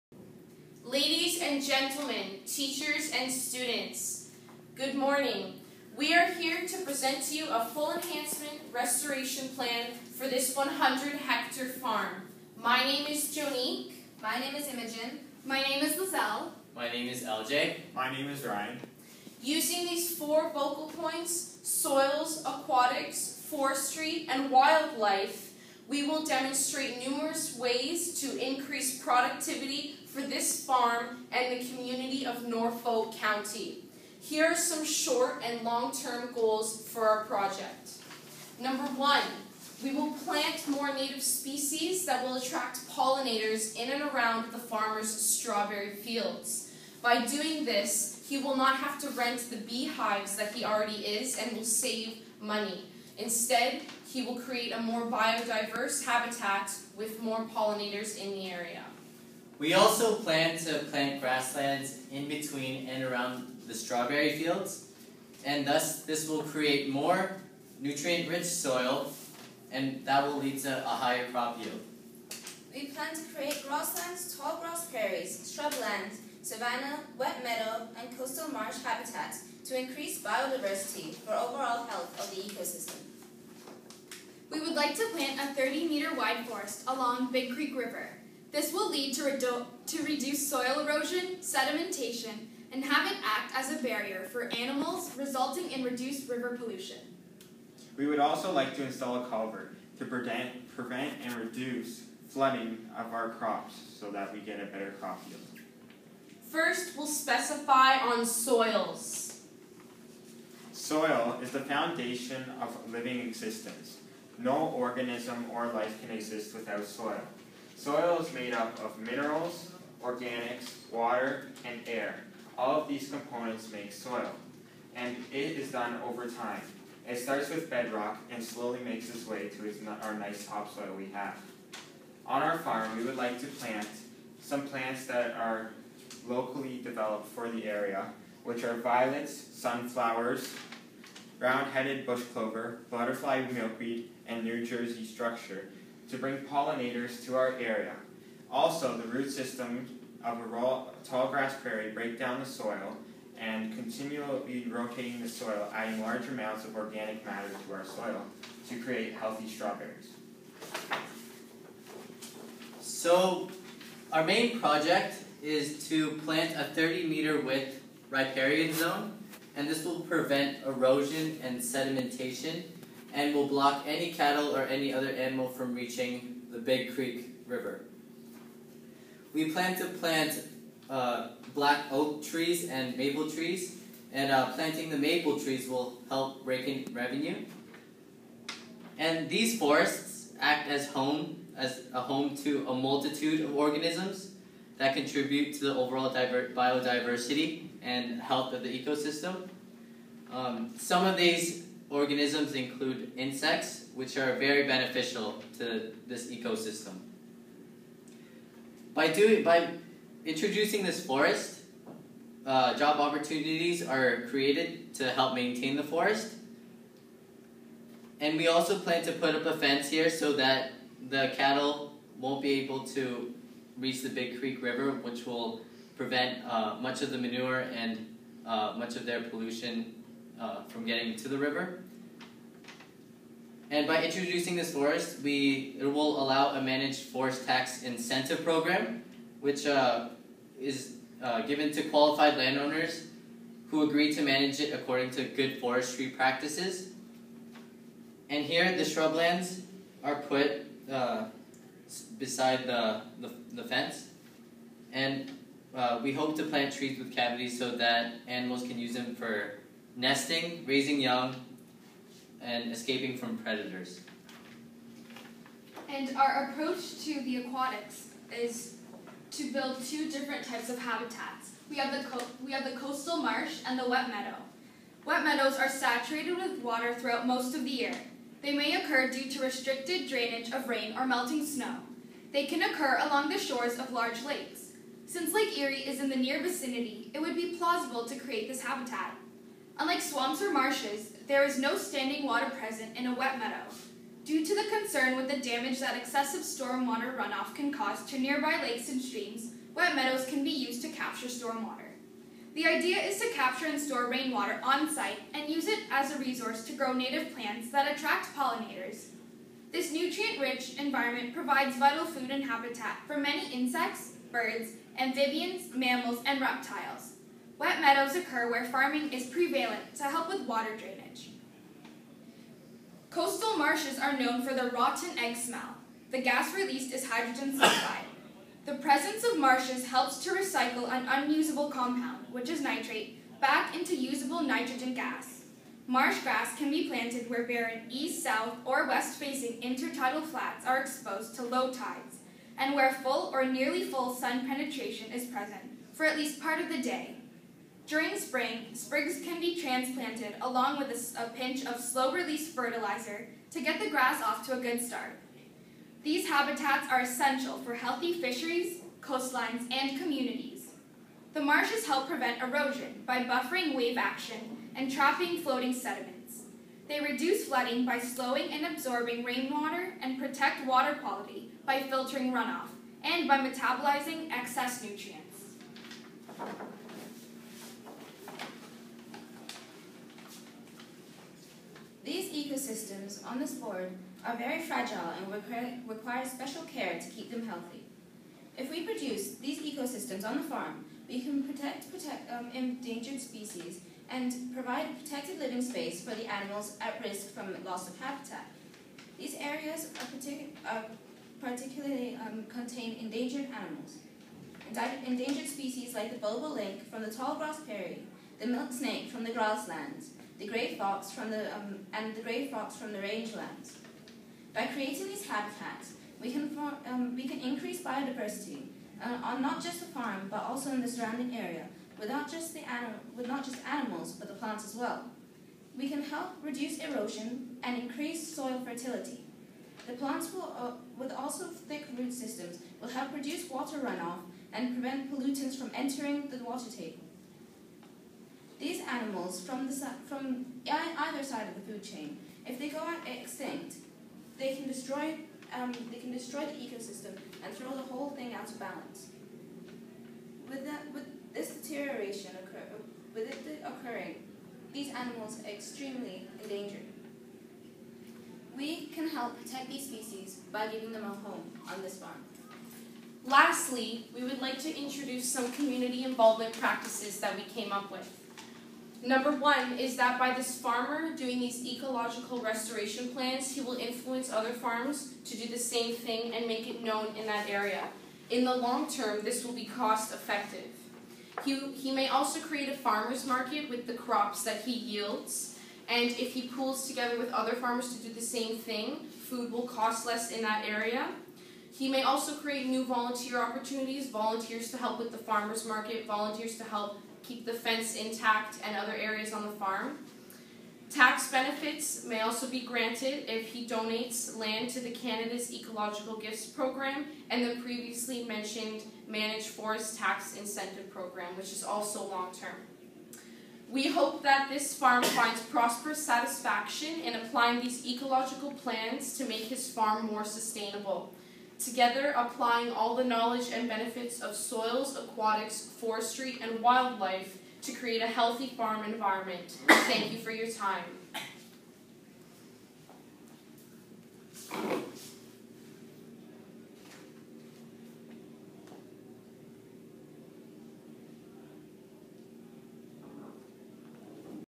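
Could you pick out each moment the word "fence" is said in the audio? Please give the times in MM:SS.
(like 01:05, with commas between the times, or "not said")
03:39, 04:13, 08:17.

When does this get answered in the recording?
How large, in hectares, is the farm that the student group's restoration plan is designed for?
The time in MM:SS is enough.
00:10.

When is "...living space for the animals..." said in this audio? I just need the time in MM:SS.
06:35.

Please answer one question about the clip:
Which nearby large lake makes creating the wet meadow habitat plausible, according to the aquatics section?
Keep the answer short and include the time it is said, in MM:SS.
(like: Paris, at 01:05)
Lake Erie, at 04:45.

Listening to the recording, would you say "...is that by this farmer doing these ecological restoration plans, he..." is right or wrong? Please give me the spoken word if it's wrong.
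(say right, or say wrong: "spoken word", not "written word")
right.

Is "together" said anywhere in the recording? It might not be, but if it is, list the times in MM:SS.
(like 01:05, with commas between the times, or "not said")
08:06, 08:41.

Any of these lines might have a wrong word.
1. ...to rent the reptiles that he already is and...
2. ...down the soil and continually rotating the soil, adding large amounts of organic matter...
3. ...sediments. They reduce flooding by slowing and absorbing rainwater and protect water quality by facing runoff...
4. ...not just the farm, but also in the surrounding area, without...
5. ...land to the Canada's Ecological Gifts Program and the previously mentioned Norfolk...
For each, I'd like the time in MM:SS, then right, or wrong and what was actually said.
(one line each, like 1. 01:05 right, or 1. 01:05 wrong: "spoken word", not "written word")
1. 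00:49 wrong: "beehives", not "reptiles"
2. 02:32 right
3. 06:05 wrong: "filtering", not "facing"
4. 06:59 right
5. 08:24 wrong: "Managed", not "Norfolk".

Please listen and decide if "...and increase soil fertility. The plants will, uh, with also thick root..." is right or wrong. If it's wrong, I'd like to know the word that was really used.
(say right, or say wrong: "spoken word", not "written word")
right.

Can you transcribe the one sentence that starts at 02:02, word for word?
All of these components make soil, and it is done over time.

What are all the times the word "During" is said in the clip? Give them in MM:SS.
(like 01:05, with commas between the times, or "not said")
05:47.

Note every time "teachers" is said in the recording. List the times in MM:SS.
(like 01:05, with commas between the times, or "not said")
00:02.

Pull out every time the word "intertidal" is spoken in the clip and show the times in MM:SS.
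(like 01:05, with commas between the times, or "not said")
05:39.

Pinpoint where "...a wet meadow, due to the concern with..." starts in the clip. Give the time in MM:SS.
04:53.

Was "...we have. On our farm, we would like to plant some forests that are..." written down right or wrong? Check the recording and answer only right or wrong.
wrong.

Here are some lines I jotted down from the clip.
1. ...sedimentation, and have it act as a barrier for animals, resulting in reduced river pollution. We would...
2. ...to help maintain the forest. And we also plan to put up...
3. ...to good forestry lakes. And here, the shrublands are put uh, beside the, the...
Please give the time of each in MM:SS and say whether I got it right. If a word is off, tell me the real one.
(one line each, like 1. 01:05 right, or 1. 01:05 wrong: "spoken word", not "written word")
1. 01:31 right
2. 03:34 right
3. 04:05 wrong: "practices", not "lakes".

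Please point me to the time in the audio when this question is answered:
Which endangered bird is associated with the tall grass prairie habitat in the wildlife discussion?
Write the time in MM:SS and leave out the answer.
06:46.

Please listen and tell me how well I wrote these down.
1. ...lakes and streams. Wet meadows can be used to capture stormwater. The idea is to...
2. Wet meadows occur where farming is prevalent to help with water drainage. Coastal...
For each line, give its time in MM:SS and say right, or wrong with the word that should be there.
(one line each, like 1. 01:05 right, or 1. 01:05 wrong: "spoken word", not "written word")
1. 04:58 right
2. 05:17 right.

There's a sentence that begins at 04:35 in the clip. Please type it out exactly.
Wet meadows are saturated with water throughout most of the year.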